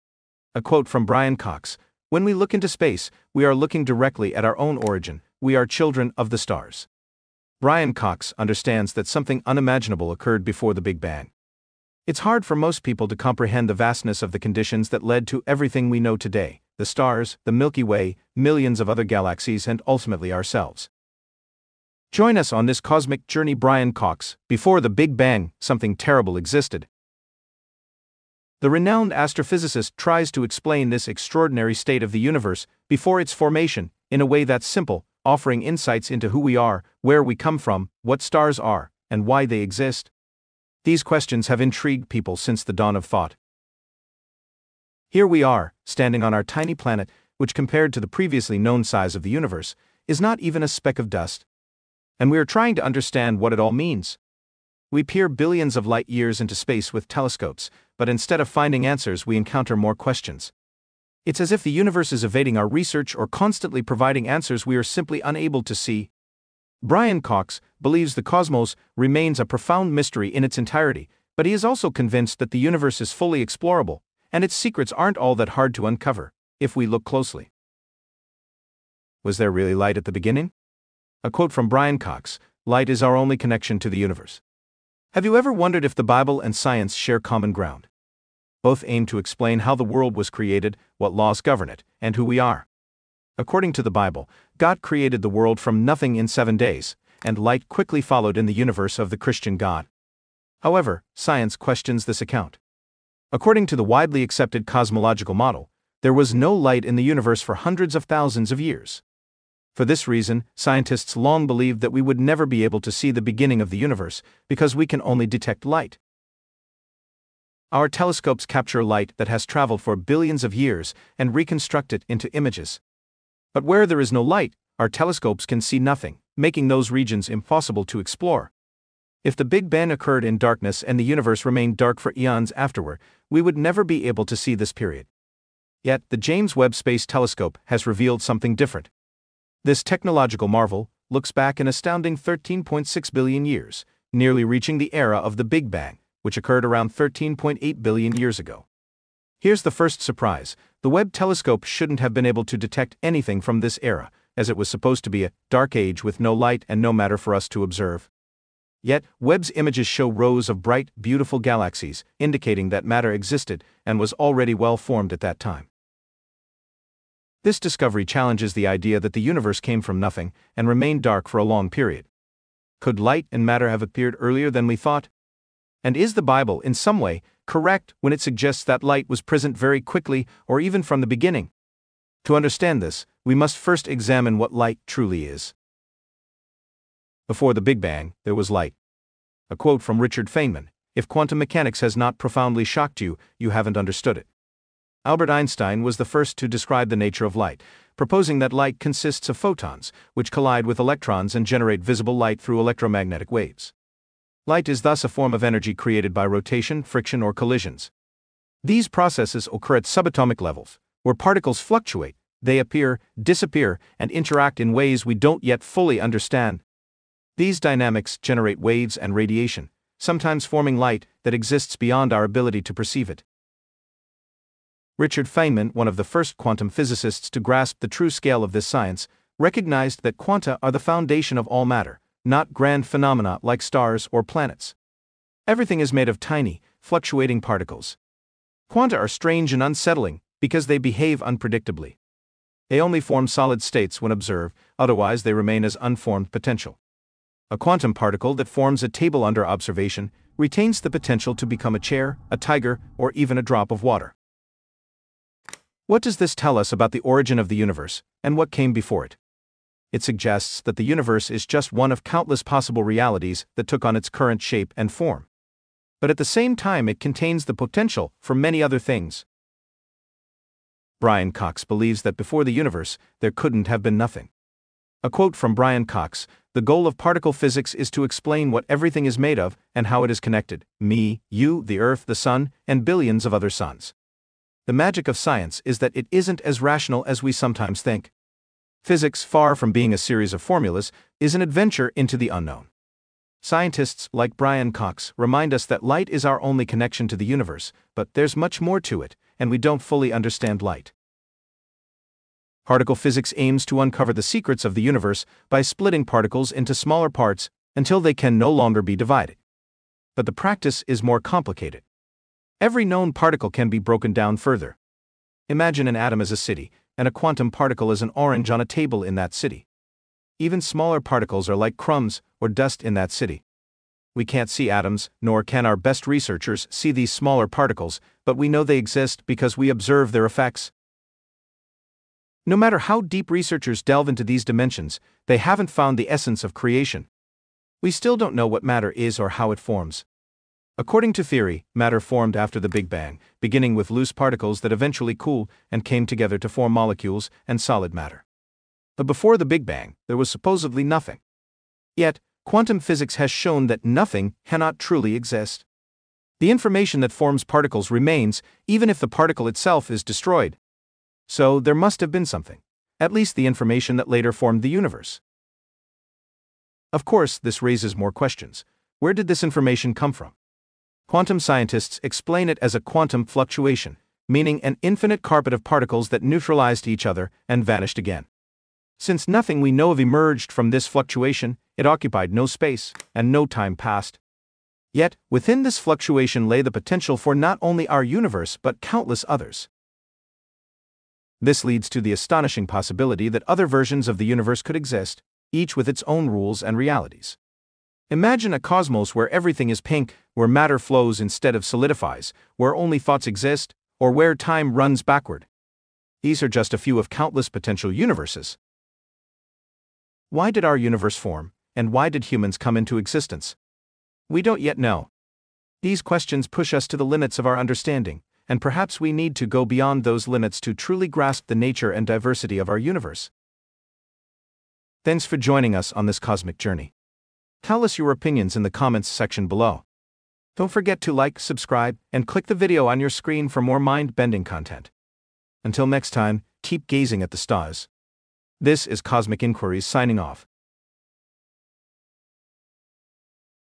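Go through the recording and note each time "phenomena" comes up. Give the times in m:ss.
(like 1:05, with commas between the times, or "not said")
3:52.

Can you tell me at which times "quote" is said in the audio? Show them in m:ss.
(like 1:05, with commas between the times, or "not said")
0:00, 1:21, 3:09, 4:35.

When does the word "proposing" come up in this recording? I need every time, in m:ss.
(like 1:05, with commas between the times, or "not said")
3:17.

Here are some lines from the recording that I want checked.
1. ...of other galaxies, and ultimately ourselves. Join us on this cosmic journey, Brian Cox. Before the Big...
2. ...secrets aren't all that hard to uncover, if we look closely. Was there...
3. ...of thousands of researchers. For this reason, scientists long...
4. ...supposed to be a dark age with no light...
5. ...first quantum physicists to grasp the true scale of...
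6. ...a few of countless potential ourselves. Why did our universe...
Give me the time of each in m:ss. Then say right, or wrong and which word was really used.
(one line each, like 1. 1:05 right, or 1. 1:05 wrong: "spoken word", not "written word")
1. 0:18 right
2. 1:14 right
3. 1:47 wrong: "years", not "researchers"
4. 2:34 right
5. 3:46 right
6. 6:46 wrong: "universes", not "ourselves".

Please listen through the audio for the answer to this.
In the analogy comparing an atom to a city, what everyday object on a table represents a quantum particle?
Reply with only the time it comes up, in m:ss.
5:18.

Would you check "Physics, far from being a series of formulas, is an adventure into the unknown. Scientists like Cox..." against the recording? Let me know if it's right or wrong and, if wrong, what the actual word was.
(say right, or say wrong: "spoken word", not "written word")
wrong: "Brian", not "Cox".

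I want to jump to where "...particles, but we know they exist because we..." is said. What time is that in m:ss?
5:27.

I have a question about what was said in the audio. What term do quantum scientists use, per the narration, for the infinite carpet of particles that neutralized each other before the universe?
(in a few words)
quantum fluctuation.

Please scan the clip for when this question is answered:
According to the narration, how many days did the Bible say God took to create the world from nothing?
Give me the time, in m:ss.
1:36.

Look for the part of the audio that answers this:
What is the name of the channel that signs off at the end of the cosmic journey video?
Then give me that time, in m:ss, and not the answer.
7:19.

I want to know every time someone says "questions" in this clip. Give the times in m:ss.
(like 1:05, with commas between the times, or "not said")
0:41, 0:59, 1:41, 6:08, 6:56.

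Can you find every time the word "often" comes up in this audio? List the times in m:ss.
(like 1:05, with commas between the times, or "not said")
not said.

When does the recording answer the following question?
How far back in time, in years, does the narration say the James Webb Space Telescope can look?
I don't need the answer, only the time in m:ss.
2:22.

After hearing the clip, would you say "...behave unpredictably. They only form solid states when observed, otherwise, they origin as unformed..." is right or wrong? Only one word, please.
wrong.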